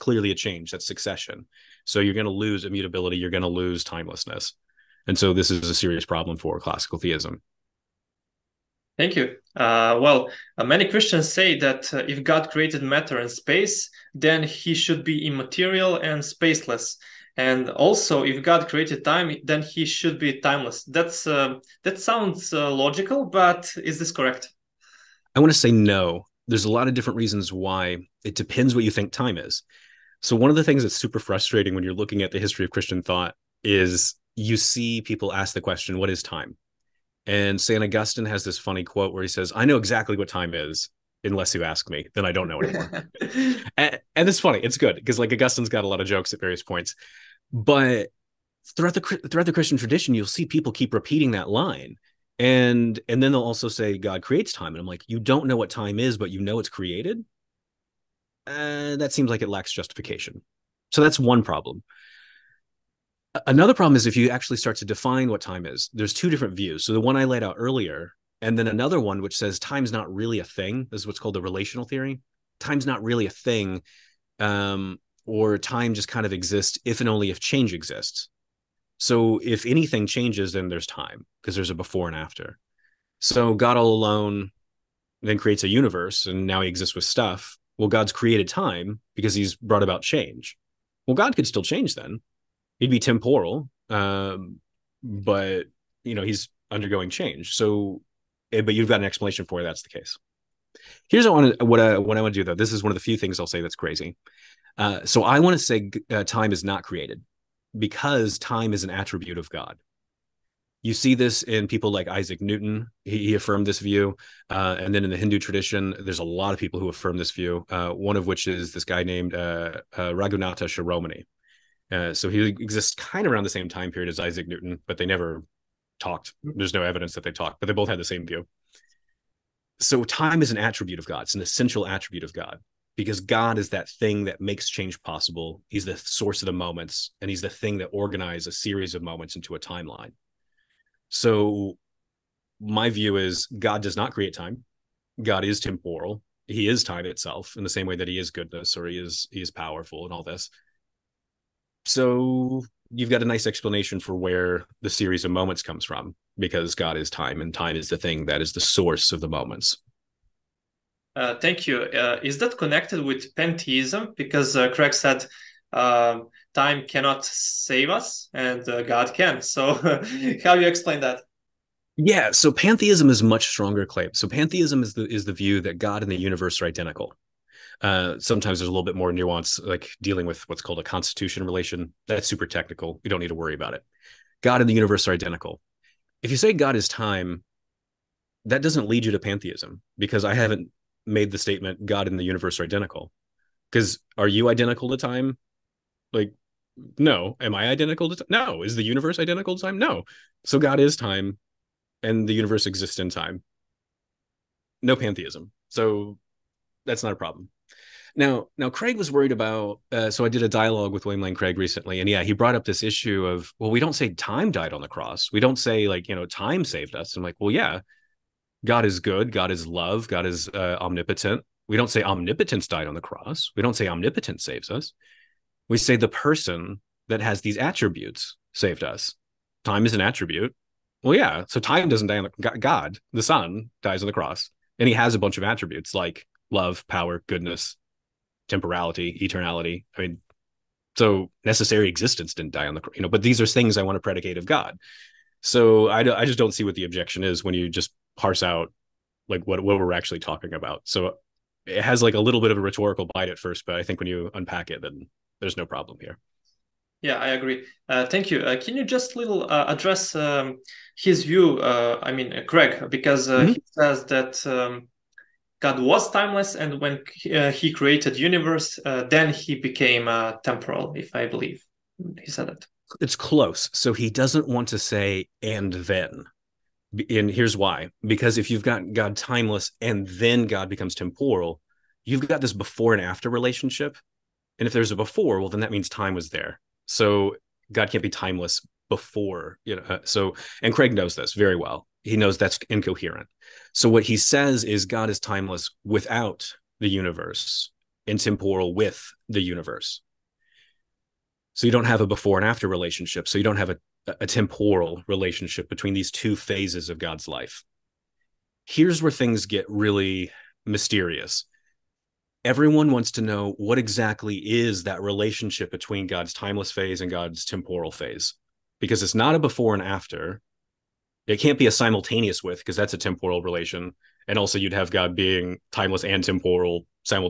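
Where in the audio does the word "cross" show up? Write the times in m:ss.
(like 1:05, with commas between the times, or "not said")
3:34, 3:43, 3:54.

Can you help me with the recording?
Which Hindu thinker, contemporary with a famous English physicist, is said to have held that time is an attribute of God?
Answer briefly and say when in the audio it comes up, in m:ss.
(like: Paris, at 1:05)
Raghunatha Shiromani, at 2:00.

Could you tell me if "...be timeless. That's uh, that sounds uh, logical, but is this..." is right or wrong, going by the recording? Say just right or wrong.
right.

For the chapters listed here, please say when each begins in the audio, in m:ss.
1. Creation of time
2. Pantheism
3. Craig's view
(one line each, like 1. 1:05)
1. 0:16
2. 2:41
3. 4:25.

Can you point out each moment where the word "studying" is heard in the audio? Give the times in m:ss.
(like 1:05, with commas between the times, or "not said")
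not said.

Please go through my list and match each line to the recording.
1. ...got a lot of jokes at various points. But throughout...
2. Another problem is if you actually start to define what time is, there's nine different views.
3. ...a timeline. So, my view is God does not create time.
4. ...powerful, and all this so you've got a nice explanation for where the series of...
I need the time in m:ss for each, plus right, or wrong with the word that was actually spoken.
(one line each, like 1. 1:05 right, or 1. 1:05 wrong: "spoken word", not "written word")
1. 0:45 right
2. 1:03 wrong: "two", not "nine"
3. 2:19 right
4. 2:29 right.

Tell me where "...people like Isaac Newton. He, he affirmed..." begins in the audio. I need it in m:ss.
1:51.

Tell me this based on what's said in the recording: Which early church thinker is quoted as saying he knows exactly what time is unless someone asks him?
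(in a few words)
St. Augustine.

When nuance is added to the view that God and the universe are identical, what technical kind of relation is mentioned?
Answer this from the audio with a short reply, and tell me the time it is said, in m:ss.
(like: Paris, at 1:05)
constitution relation, at 3:00.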